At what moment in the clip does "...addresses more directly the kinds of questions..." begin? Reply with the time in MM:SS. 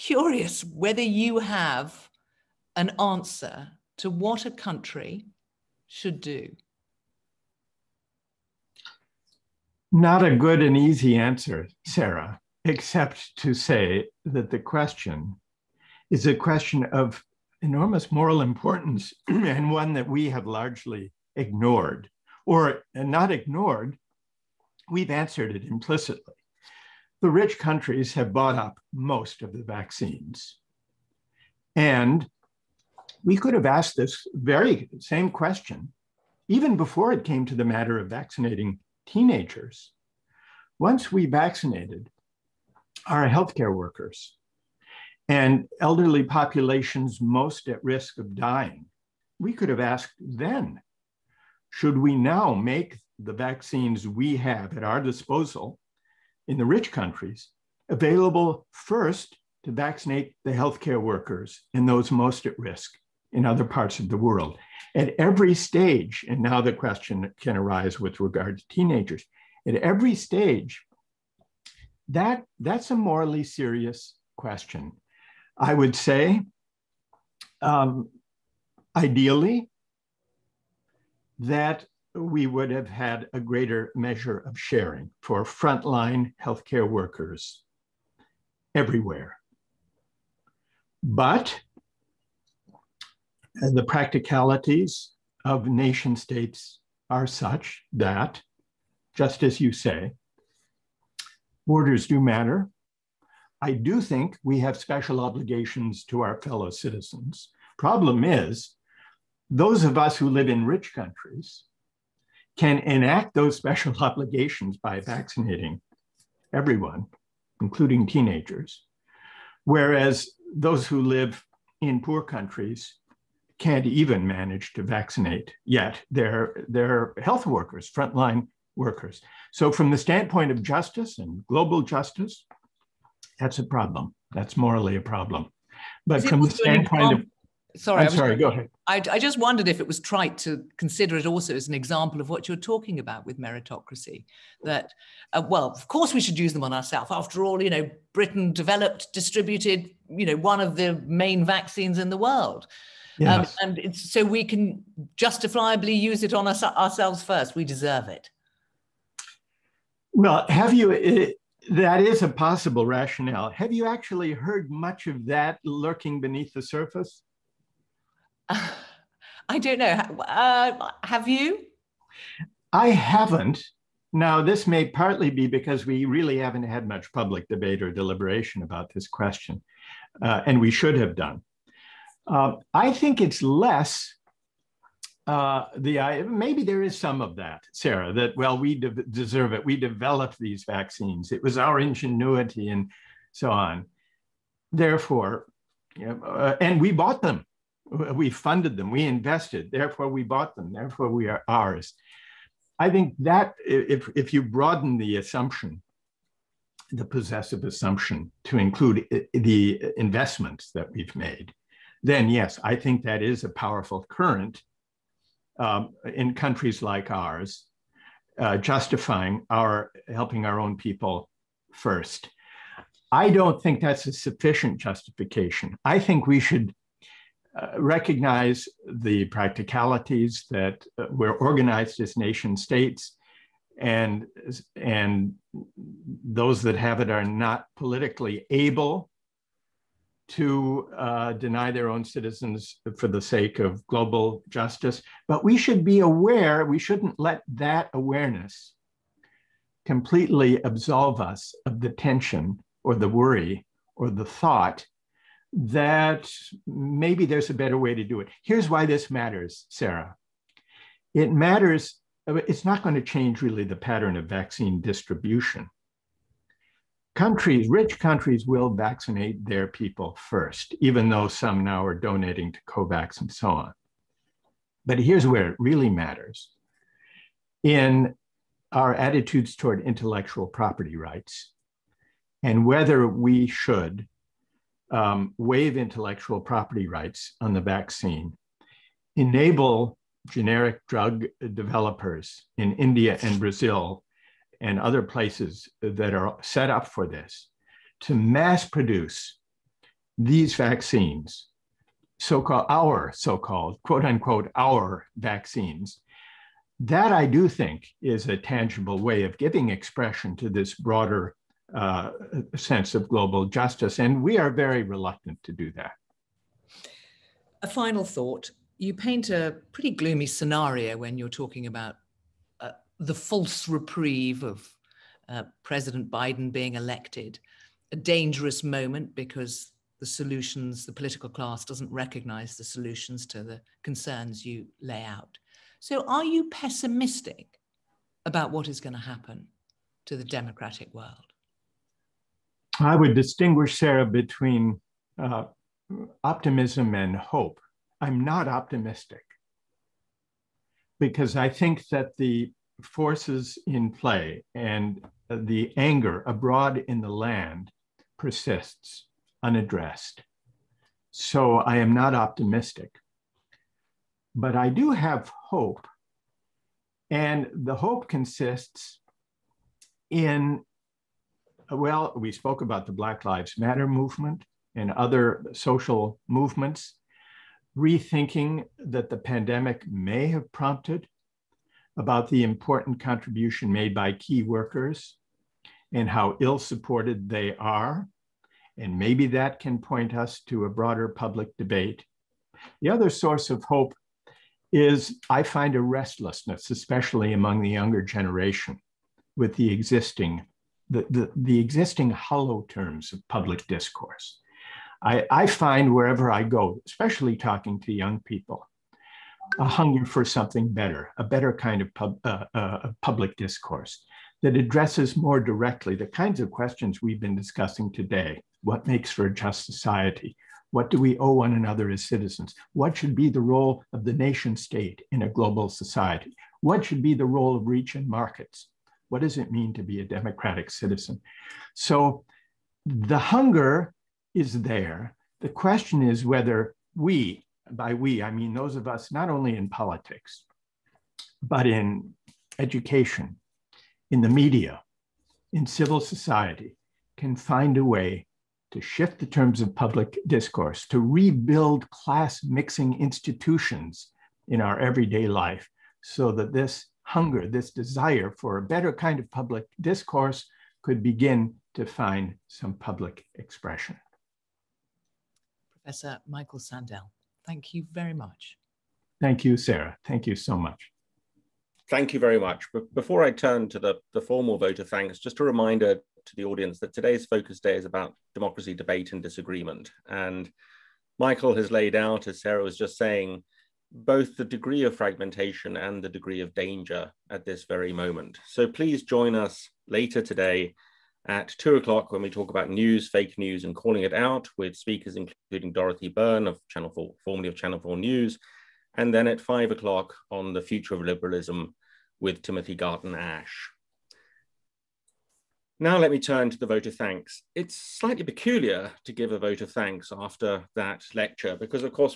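06:54.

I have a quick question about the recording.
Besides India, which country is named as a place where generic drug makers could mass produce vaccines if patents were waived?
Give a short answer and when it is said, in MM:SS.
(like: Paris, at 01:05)
Brazil, at 04:53.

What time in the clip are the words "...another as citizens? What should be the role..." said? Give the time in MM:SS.
07:01.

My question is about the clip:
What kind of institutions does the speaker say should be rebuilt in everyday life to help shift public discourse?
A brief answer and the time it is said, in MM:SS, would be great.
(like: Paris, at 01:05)
class mixing institutions, at 07:31.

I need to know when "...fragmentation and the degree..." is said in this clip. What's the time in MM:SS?
08:04.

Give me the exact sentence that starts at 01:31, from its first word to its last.
But the practicalities of nation states are such that, just as you say, borders do matter.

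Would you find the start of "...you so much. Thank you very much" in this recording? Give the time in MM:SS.
07:50.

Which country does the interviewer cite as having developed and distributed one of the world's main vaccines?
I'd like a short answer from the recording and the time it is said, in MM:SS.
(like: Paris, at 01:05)
Britain, at 02:28.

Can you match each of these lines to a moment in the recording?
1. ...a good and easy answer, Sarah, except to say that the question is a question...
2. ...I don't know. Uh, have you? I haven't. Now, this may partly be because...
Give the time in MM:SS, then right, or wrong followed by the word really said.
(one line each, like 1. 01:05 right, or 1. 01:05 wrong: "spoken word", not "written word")
1. 00:10 right
2. 02:49 right.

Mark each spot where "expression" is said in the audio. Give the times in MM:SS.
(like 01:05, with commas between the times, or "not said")
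05:09, 07:43.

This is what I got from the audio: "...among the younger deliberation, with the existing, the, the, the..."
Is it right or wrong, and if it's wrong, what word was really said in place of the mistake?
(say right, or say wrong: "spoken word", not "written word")
wrong: "generation", not "deliberation".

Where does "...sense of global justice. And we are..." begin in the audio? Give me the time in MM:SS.
05:12.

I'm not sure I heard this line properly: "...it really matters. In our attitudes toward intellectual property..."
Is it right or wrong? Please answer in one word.
right.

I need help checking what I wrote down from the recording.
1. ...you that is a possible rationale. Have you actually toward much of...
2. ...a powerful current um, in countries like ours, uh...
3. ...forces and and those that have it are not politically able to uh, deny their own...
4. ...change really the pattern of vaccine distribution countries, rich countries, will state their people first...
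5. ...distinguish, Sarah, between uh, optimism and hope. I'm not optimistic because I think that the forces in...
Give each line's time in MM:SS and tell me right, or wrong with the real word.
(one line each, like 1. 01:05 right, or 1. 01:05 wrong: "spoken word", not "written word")
1. 02:40 wrong: "heard", not "toward"
2. 03:33 right
3. 03:52 wrong: "states", not "forces"
4. 04:23 wrong: "vaccinate", not "state"
5. 05:43 right.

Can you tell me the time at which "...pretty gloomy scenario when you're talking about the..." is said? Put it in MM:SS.
05:19.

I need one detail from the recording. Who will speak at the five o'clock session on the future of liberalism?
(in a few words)
Timothy Garton Ash.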